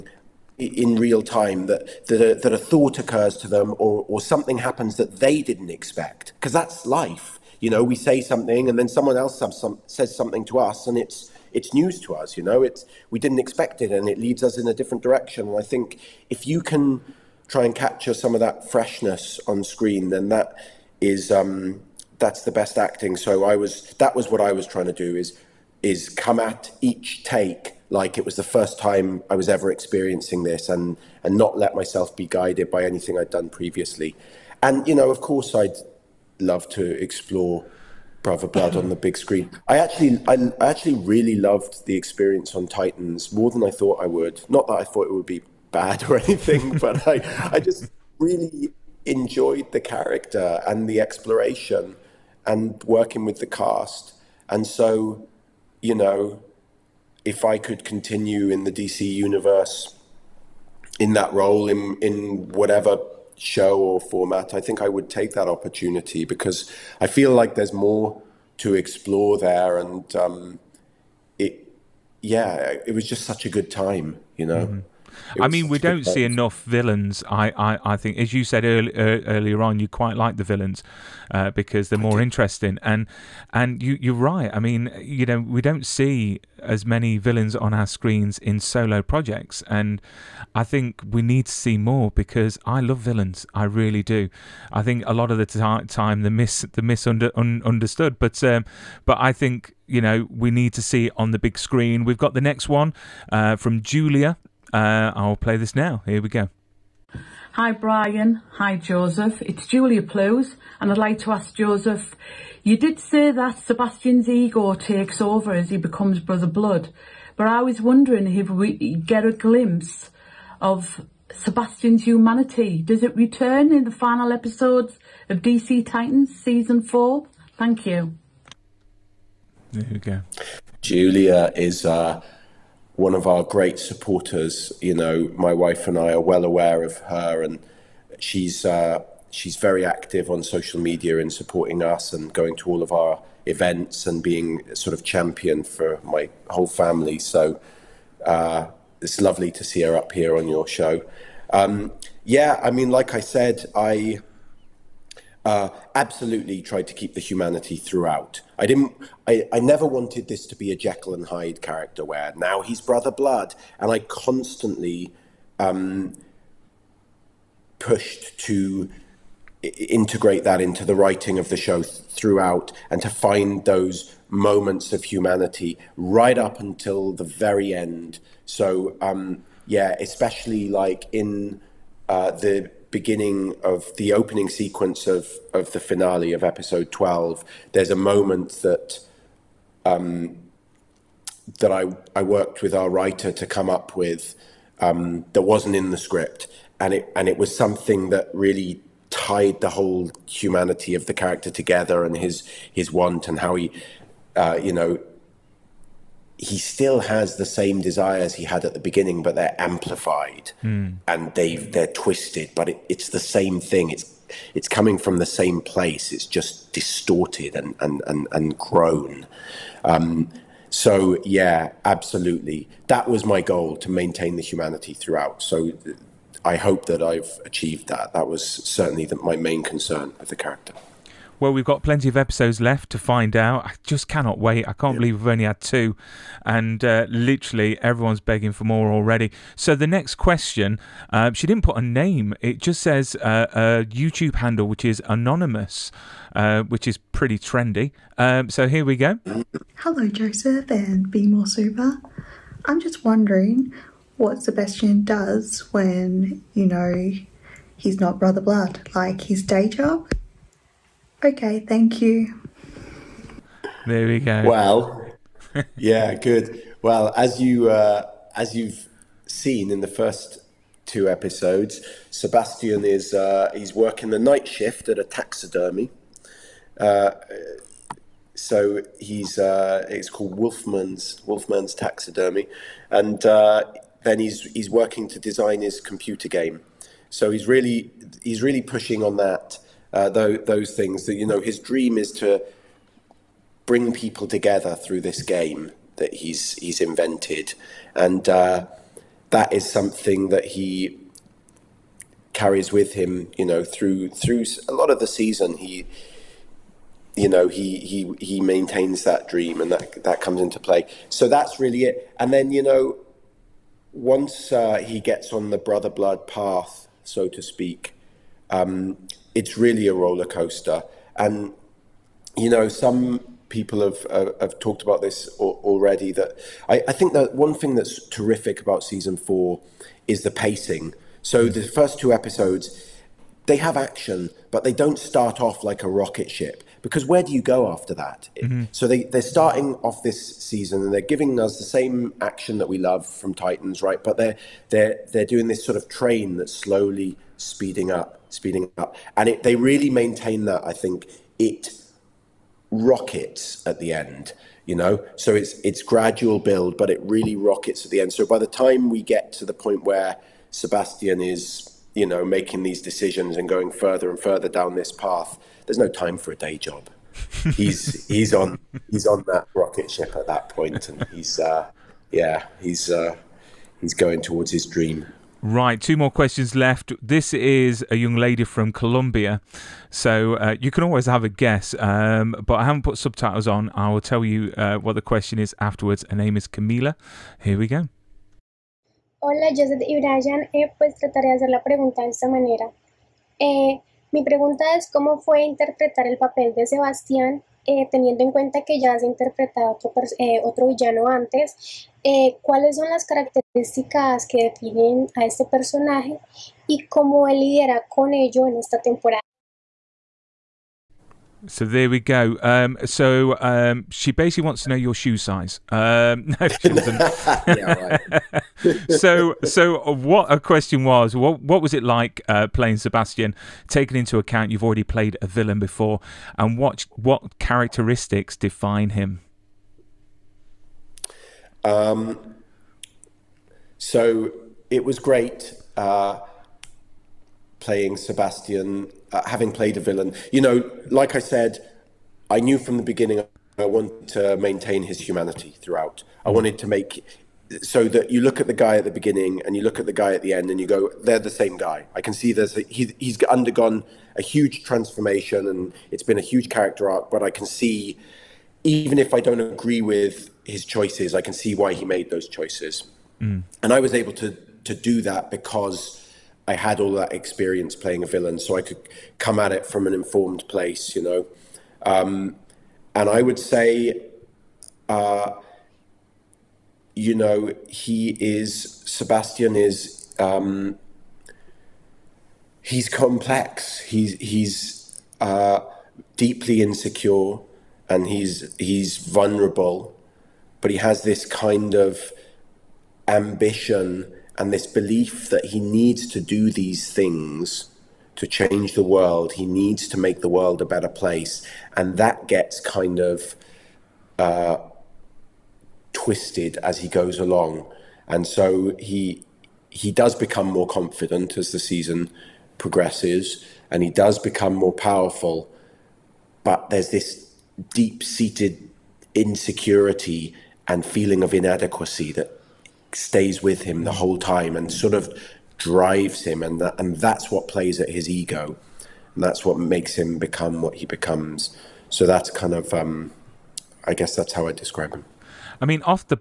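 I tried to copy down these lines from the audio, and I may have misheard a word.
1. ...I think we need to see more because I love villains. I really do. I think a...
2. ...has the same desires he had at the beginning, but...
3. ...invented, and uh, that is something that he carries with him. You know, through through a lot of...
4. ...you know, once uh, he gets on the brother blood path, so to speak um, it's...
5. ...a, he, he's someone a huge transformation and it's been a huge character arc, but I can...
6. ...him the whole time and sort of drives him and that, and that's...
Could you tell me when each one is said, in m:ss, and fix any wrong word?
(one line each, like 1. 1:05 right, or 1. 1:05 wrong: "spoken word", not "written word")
1. 1:30 right
2. 3:26 right
3. 4:56 right
4. 5:12 right
5. 7:32 wrong: "undergone", not "someone"
6. 8:43 right.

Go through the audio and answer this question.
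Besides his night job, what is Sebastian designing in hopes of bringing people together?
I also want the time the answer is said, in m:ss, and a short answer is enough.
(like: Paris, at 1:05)
computer game, at 4:45.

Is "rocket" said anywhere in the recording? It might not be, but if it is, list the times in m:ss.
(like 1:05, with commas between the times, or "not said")
5:35, 5:52, 5:57, 6:09.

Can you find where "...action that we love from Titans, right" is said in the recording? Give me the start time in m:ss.
5:42.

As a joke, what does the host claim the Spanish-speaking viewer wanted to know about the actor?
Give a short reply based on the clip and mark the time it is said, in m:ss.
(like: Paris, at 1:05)
shoe size, at 6:54.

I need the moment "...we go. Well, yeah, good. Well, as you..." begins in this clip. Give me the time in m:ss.
4:24.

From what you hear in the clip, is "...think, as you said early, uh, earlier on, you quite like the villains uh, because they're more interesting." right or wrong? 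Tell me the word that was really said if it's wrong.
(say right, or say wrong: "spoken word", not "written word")
right.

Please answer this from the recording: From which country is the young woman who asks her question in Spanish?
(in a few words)
Colombia.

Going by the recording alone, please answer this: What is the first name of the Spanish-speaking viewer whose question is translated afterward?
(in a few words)
Camila.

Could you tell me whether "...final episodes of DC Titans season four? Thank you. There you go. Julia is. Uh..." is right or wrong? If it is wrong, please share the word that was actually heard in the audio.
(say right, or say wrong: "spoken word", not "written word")
right.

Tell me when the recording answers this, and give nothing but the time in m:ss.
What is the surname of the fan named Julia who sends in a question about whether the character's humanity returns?
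1:50.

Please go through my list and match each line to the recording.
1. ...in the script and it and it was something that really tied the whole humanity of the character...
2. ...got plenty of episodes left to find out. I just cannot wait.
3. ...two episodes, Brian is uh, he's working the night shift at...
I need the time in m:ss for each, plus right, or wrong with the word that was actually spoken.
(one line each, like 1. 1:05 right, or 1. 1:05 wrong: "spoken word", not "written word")
1. 3:15 right
2. 3:51 right
3. 4:30 wrong: "Sebastian", not "Brian".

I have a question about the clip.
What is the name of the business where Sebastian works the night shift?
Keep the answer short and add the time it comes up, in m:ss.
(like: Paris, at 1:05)
Wolfman's Taxidermy, at 4:41.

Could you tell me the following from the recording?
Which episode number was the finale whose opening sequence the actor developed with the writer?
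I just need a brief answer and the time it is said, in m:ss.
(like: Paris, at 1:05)
12, at 3:06.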